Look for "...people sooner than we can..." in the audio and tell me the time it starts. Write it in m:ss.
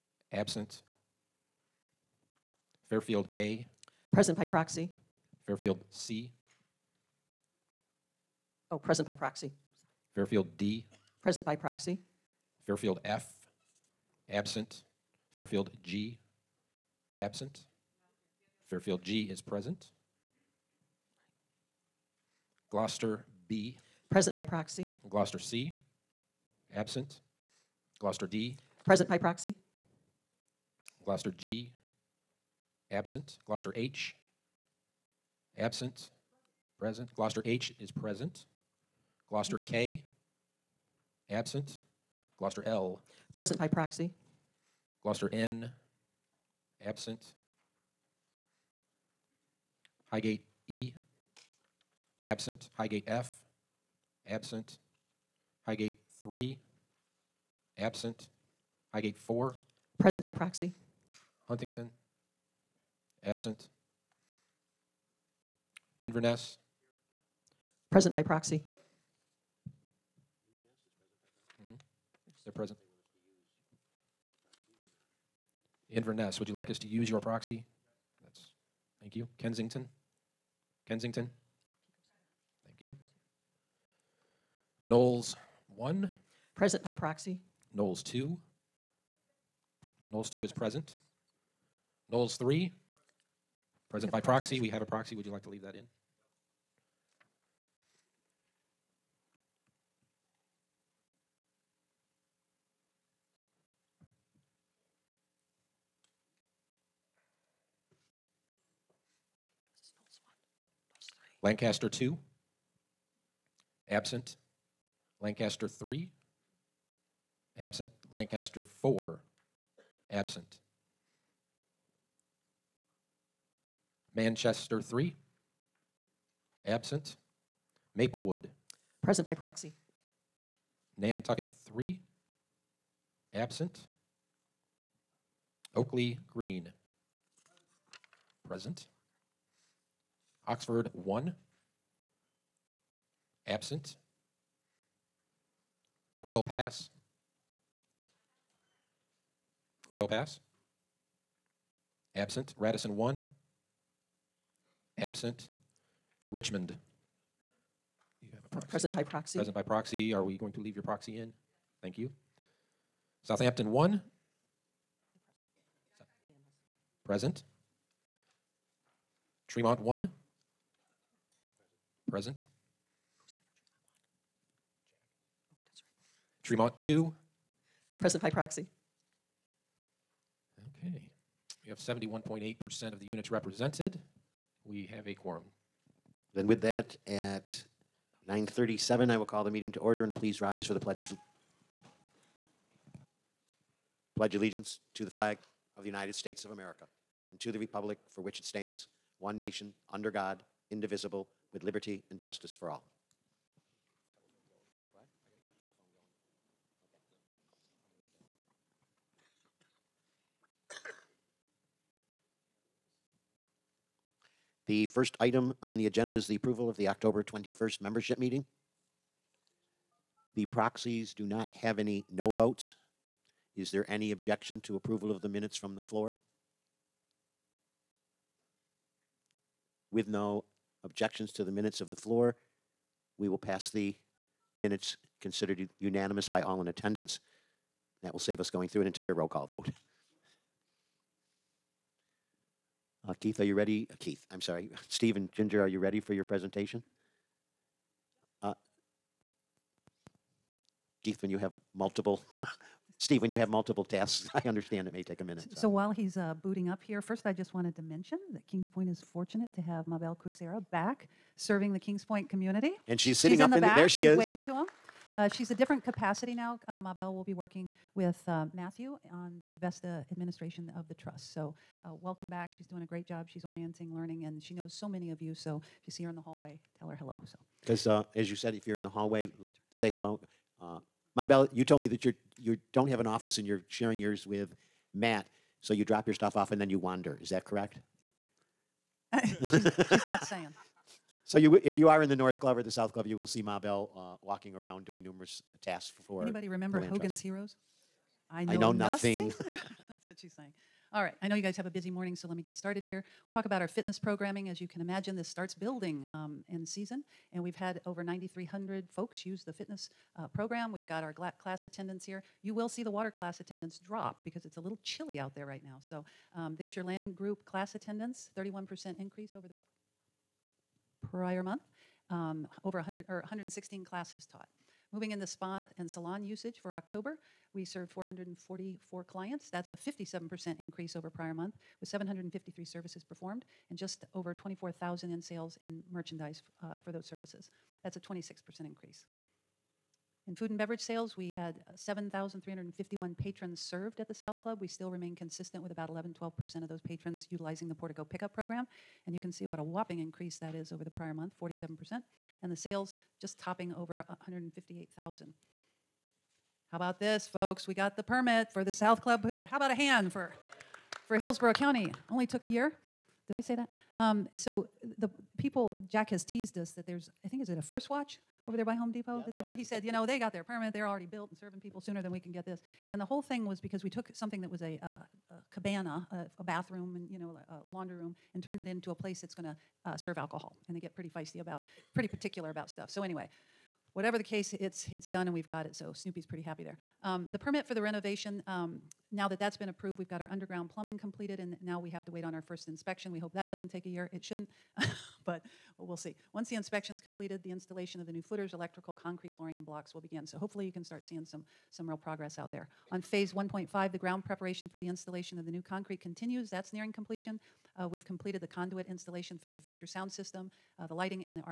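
6:11.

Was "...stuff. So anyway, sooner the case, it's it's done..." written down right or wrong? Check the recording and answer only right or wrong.
wrong.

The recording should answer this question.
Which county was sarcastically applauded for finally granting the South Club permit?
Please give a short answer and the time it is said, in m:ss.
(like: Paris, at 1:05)
Hillsborough County, at 6:01.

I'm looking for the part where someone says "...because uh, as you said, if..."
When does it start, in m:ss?
4:37.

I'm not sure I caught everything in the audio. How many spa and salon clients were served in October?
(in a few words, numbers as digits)
444.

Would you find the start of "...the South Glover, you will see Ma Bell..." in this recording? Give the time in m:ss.
4:52.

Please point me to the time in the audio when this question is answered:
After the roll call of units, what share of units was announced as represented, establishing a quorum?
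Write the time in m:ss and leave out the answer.
3:01.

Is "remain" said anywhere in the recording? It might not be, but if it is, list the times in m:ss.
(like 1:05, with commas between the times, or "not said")
5:44.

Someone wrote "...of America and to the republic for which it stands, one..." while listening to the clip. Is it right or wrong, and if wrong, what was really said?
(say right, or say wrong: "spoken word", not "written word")
right.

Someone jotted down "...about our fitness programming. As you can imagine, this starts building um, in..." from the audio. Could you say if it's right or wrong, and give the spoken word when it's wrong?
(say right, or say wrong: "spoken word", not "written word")
right.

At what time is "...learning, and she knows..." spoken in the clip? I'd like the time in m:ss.
4:33.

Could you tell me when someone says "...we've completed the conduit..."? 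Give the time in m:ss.
6:47.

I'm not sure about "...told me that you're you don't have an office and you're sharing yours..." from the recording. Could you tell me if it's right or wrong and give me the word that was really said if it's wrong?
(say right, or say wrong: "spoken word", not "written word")
right.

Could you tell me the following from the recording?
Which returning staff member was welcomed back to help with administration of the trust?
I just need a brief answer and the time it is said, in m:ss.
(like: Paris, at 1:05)
Mabel Cusera, at 4:19.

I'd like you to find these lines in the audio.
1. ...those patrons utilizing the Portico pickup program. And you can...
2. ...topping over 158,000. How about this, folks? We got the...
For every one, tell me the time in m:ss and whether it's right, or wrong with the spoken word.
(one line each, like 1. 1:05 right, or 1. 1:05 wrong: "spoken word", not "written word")
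1. 5:46 right
2. 5:53 right.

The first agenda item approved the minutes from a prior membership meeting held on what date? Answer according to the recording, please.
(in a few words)
October 21st.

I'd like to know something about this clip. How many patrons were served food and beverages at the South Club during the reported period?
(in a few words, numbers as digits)
7,351.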